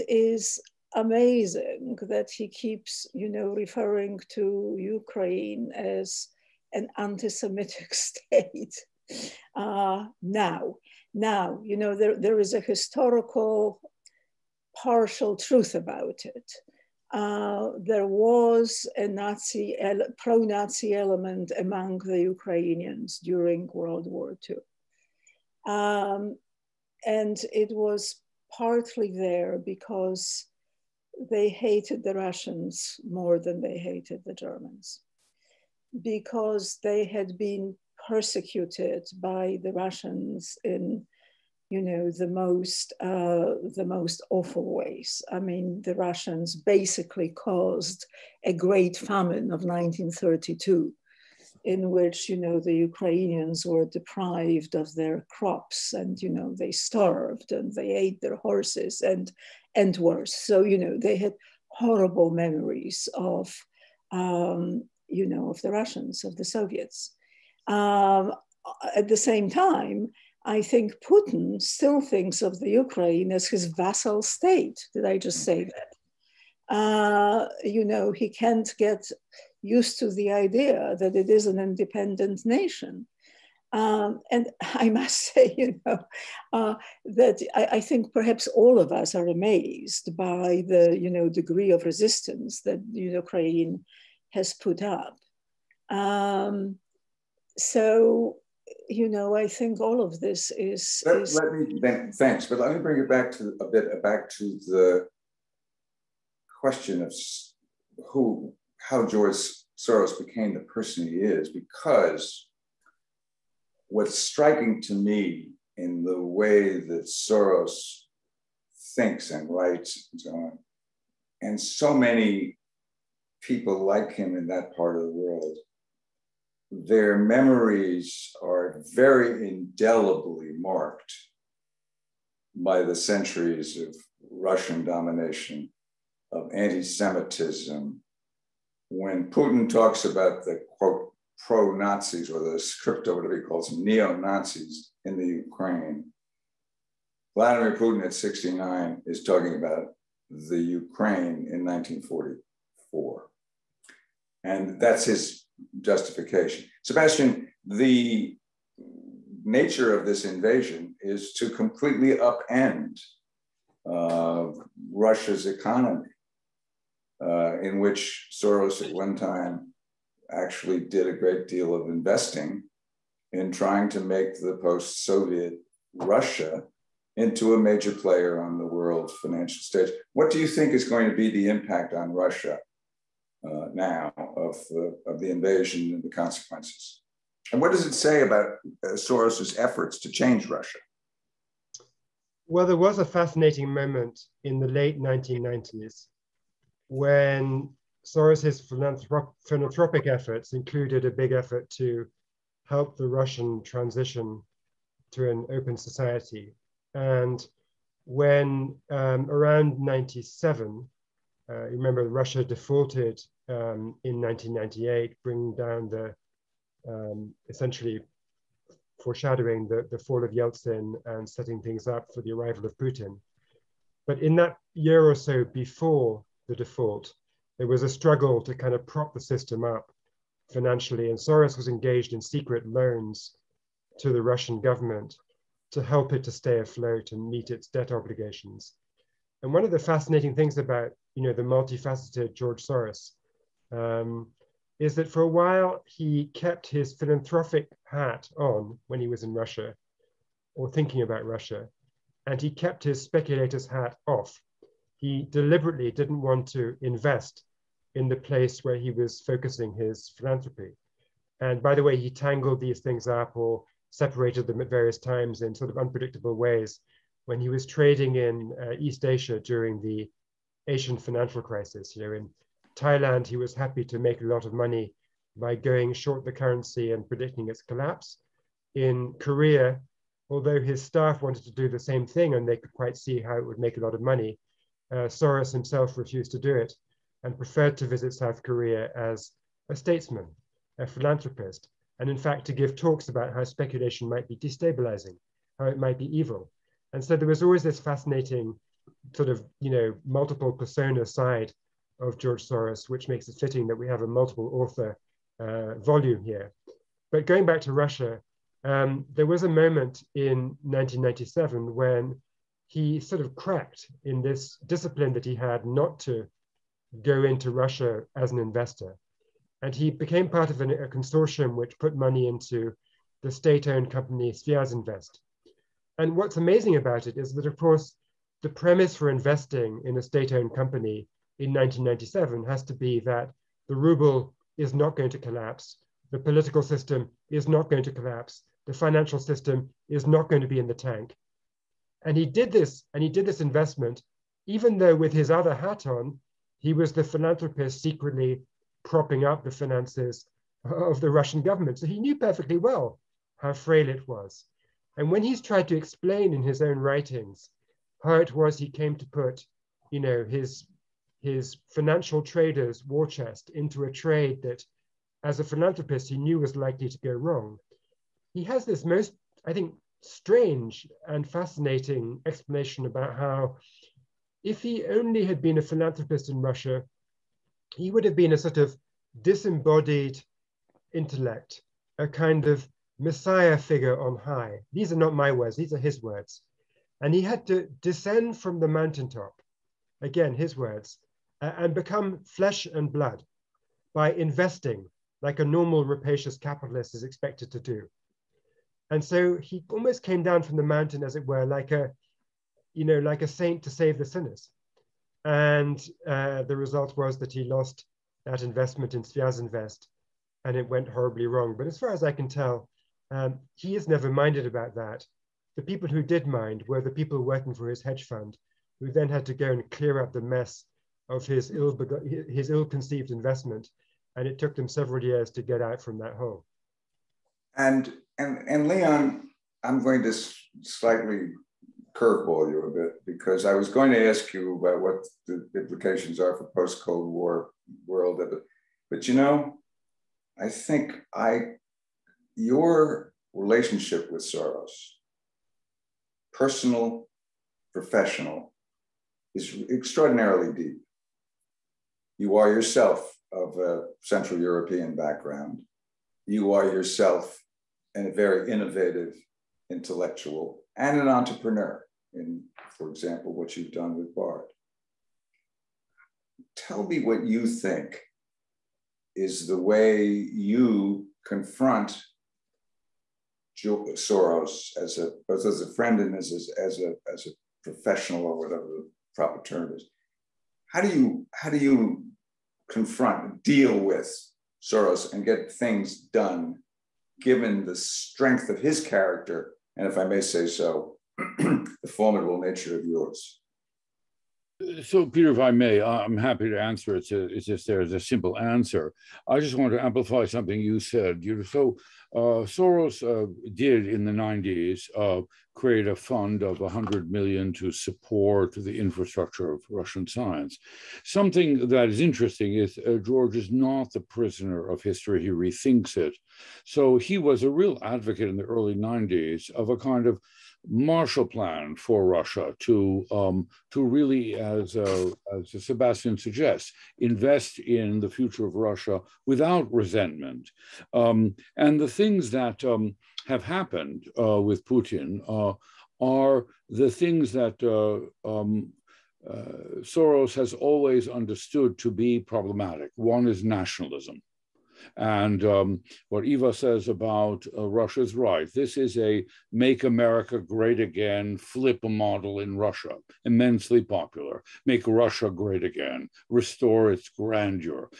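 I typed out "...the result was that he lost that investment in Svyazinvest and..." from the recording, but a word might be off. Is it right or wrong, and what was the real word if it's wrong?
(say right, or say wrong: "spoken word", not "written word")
right.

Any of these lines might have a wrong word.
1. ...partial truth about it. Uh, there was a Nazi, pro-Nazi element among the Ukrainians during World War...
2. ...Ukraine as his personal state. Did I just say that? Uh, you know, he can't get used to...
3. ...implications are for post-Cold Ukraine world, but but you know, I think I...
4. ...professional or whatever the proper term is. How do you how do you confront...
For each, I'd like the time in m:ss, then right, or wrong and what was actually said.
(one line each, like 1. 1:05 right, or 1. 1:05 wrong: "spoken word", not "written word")
1. 0:14 right
2. 1:12 wrong: "vassal", not "personal"
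3. 7:15 wrong: "War", not "Ukraine"
4. 7:57 right.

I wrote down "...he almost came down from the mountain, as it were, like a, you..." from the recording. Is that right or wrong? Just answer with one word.
right.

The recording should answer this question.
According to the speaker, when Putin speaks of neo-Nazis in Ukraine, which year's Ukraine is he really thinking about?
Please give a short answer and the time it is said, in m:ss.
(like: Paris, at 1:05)
1944, at 2:31.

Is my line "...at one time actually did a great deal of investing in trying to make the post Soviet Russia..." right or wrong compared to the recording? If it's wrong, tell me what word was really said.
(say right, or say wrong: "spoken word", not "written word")
right.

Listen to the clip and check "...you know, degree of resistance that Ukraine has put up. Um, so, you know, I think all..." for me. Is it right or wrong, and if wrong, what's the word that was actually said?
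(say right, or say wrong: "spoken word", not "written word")
right.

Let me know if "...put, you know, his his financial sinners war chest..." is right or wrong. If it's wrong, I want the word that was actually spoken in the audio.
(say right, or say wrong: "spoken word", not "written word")
wrong: "traders", not "sinners".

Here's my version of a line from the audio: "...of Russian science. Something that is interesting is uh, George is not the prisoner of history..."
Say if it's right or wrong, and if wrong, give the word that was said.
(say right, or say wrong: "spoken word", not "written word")
right.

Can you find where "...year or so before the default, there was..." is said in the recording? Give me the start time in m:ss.
3:44.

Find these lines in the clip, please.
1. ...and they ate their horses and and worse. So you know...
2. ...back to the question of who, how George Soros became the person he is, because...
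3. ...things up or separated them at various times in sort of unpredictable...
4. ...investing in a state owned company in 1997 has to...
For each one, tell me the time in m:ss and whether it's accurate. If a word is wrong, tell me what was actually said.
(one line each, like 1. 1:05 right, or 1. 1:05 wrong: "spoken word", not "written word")
1. 0:57 right
2. 1:44 right
3. 4:22 right
4. 5:29 right.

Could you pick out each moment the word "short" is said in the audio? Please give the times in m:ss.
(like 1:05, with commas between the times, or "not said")
4:35.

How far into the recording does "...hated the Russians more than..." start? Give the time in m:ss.
0:31.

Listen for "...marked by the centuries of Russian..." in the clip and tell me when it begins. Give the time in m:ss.
2:10.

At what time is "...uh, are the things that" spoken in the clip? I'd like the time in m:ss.
8:55.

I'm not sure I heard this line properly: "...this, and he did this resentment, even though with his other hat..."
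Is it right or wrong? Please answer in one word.
wrong.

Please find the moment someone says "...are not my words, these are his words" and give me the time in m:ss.
6:24.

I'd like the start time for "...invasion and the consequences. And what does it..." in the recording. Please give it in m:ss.
3:05.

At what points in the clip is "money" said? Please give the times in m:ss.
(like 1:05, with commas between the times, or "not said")
4:34, 4:44, 5:21.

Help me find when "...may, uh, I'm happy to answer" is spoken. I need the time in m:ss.
8:15.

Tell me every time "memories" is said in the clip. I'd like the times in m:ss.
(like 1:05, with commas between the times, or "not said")
1:02, 2:07.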